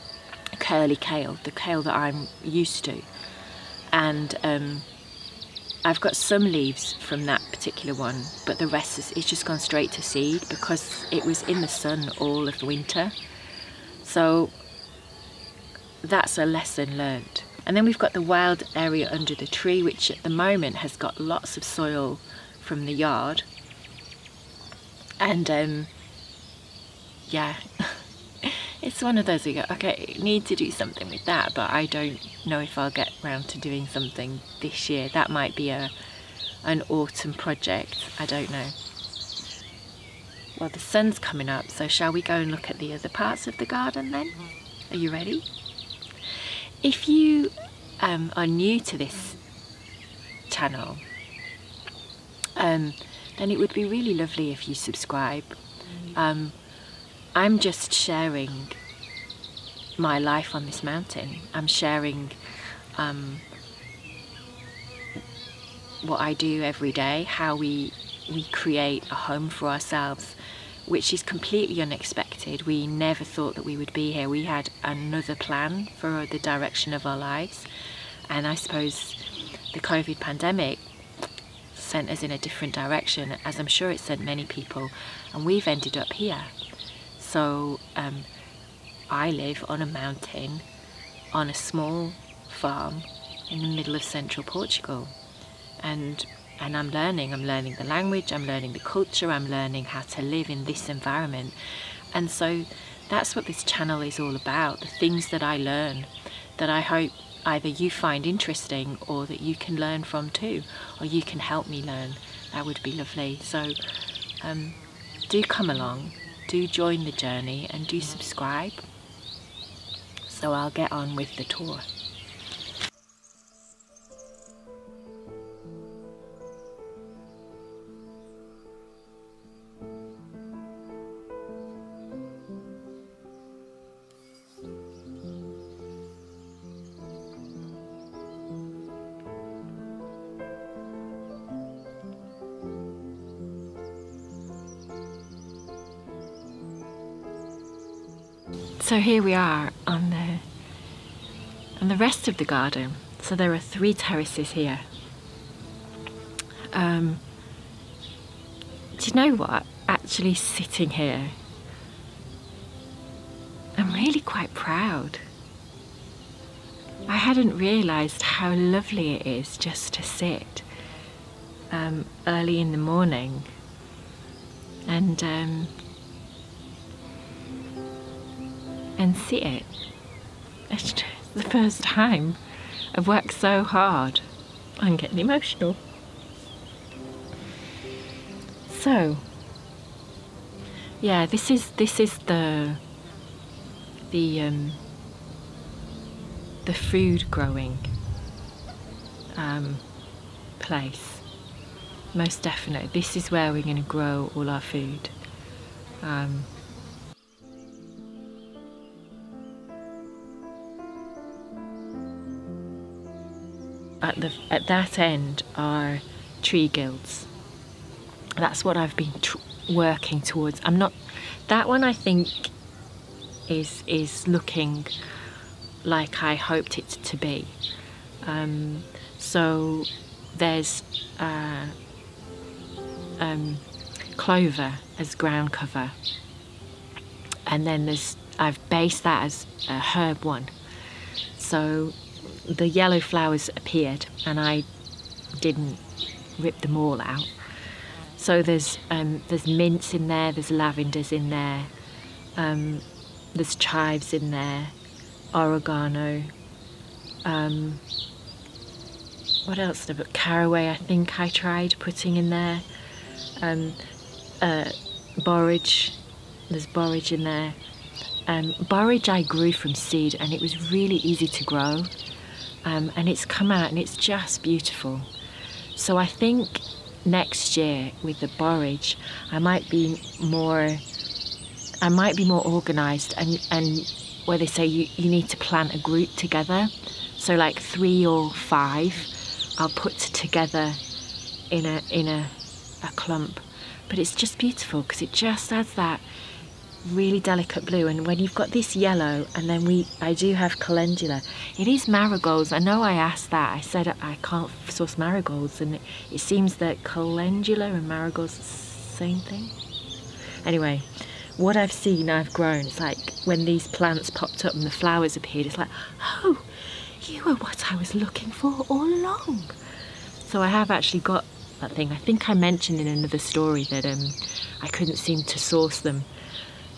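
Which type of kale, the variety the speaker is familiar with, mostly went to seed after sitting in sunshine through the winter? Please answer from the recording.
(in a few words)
Curly kale.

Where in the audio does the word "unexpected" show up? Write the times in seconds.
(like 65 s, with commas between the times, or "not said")
71 s.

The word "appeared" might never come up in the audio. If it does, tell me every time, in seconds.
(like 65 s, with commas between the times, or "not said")
243 s, 315 s.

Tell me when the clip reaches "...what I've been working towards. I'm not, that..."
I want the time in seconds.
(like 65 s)
218 s.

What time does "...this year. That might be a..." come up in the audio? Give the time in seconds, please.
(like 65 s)
34 s.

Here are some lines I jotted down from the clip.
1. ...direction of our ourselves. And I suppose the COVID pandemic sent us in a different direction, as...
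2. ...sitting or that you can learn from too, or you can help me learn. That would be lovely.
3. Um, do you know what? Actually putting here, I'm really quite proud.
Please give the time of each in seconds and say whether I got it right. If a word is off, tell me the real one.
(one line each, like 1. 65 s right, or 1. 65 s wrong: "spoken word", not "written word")
1. 76 s wrong: "lives", not "ourselves"
2. 108 s wrong: "interesting", not "sitting"
3. 156 s wrong: "sitting", not "putting".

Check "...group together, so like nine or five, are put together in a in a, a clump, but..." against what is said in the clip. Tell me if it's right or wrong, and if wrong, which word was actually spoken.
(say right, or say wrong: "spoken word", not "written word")
wrong: "three", not "nine".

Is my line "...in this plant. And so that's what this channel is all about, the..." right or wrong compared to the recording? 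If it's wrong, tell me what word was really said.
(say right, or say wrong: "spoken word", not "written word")
wrong: "environment", not "plant".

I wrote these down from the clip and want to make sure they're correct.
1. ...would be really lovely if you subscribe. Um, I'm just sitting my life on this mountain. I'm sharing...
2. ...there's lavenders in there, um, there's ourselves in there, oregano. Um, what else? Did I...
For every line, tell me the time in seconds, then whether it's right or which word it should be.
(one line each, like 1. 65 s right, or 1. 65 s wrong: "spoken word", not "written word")
1. 53 s wrong: "sharing", not "sitting"
2. 250 s wrong: "chives", not "ourselves".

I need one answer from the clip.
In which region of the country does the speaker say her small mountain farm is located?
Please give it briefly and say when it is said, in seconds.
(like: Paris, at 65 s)
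Central Portugal, at 94 s.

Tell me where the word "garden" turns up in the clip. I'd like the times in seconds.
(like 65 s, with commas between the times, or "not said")
43 s, 152 s.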